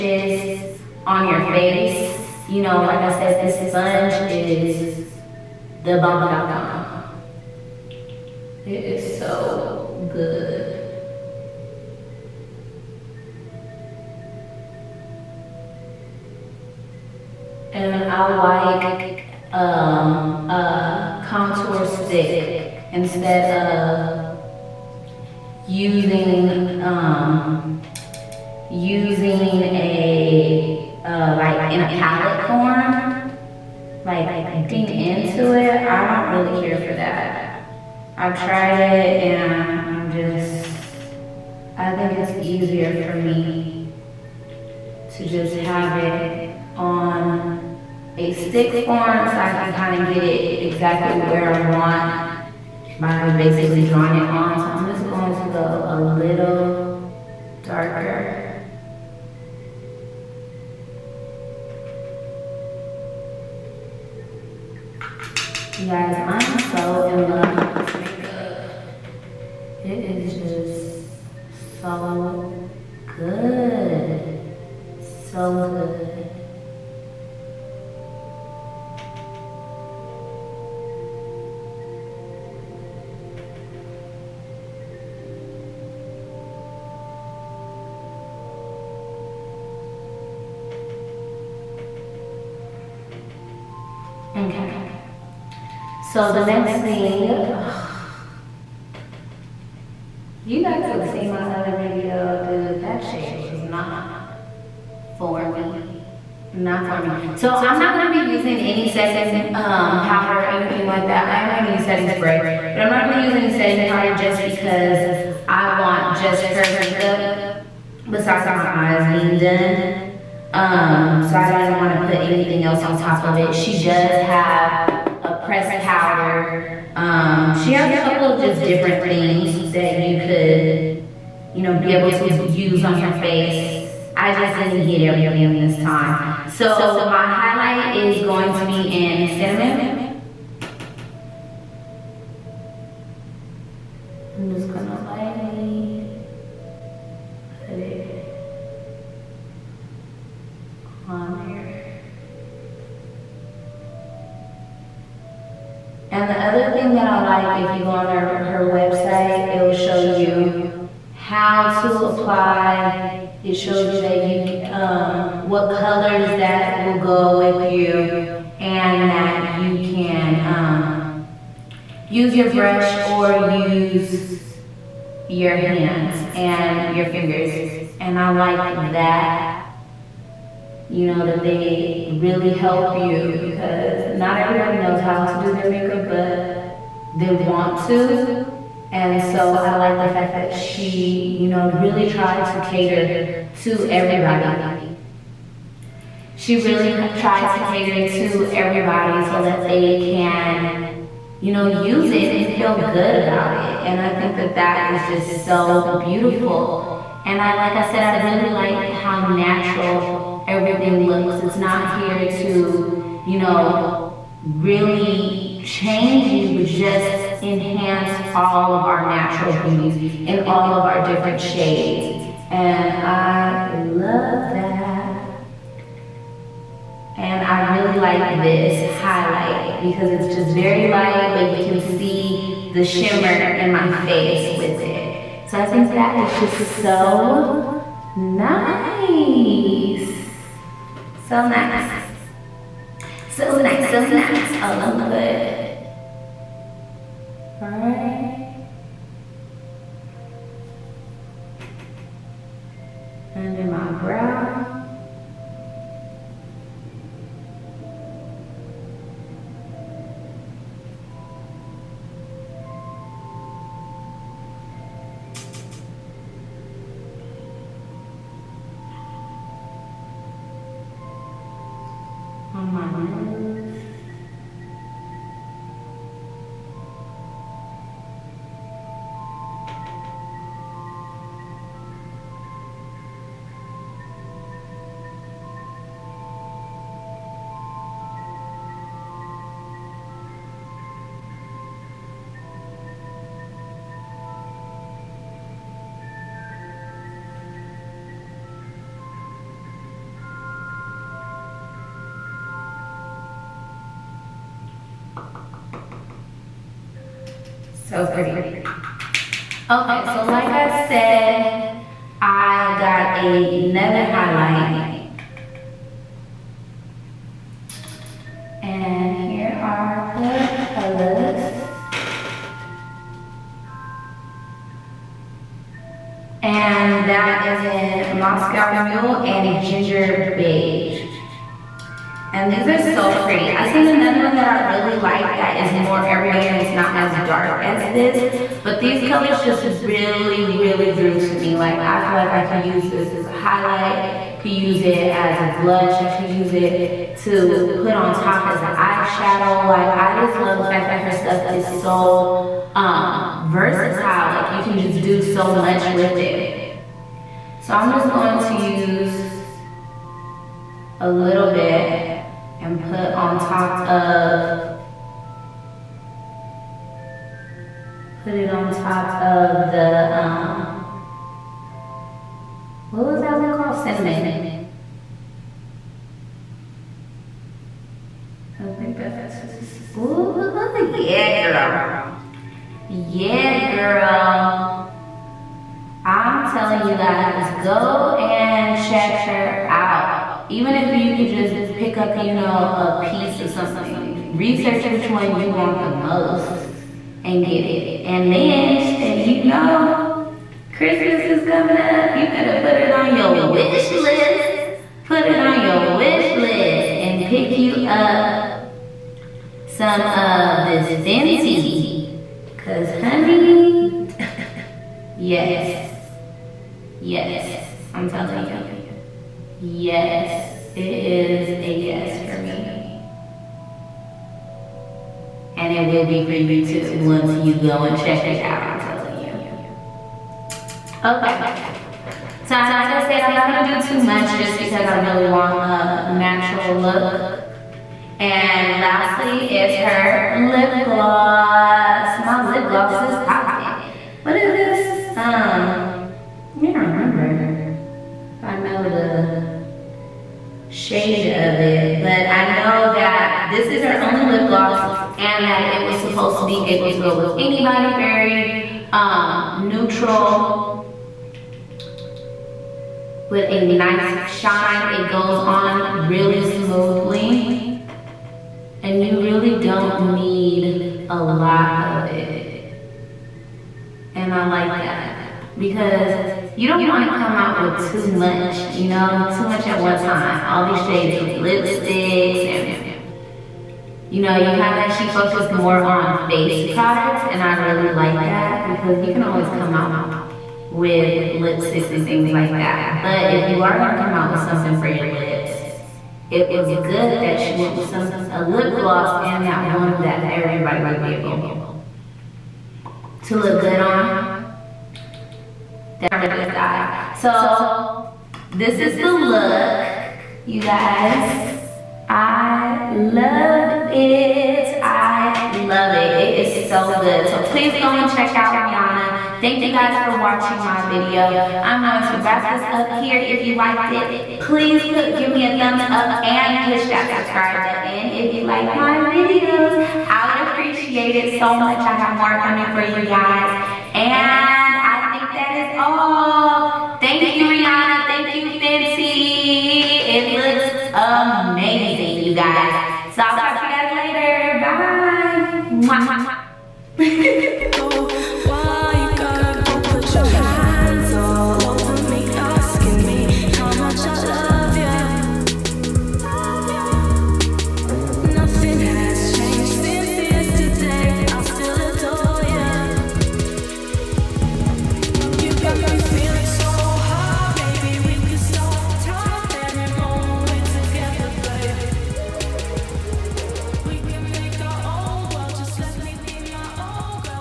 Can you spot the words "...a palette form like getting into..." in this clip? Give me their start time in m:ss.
0:31.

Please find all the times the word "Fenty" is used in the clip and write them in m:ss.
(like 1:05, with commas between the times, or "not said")
6:50, 8:58.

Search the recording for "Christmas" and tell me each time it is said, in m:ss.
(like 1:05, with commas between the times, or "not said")
6:40.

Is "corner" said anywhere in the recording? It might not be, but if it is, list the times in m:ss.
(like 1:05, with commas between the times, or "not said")
not said.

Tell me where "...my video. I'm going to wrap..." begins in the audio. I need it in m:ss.
8:40.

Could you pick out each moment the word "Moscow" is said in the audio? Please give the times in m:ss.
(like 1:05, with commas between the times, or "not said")
5:28.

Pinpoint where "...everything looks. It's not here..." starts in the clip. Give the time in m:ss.
3:30.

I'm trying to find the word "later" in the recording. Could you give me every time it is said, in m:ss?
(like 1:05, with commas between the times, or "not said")
9:03.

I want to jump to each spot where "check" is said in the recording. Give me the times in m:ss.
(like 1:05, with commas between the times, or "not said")
6:28, 7:07, 8:38.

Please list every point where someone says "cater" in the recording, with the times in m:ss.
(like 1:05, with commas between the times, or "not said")
3:12, 3:17.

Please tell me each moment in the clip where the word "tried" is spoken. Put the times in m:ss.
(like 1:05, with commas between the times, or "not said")
0:38, 3:12, 3:17.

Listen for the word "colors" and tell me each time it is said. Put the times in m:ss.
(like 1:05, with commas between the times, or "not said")
2:45, 5:20, 5:39.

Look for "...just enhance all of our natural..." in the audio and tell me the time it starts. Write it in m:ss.
3:36.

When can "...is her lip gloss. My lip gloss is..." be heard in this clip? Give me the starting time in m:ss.
7:19.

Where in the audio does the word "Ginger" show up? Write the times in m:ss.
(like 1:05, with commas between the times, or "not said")
5:29.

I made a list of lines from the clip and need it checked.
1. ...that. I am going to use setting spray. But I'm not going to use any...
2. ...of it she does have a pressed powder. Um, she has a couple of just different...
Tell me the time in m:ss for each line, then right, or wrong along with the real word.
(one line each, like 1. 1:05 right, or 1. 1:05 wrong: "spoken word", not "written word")
1. 1:51 right
2. 2:03 right.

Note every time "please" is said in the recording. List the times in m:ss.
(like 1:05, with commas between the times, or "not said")
8:37, 8:44.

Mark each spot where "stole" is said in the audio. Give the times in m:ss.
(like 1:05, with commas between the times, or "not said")
not said.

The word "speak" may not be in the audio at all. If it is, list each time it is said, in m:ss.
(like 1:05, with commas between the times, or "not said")
not said.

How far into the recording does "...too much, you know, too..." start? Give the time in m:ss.
7:57.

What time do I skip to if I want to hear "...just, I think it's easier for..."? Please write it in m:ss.
0:40.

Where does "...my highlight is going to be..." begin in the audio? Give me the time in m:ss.
2:17.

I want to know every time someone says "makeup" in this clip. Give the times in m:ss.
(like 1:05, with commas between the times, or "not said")
1:07, 1:56, 3:05.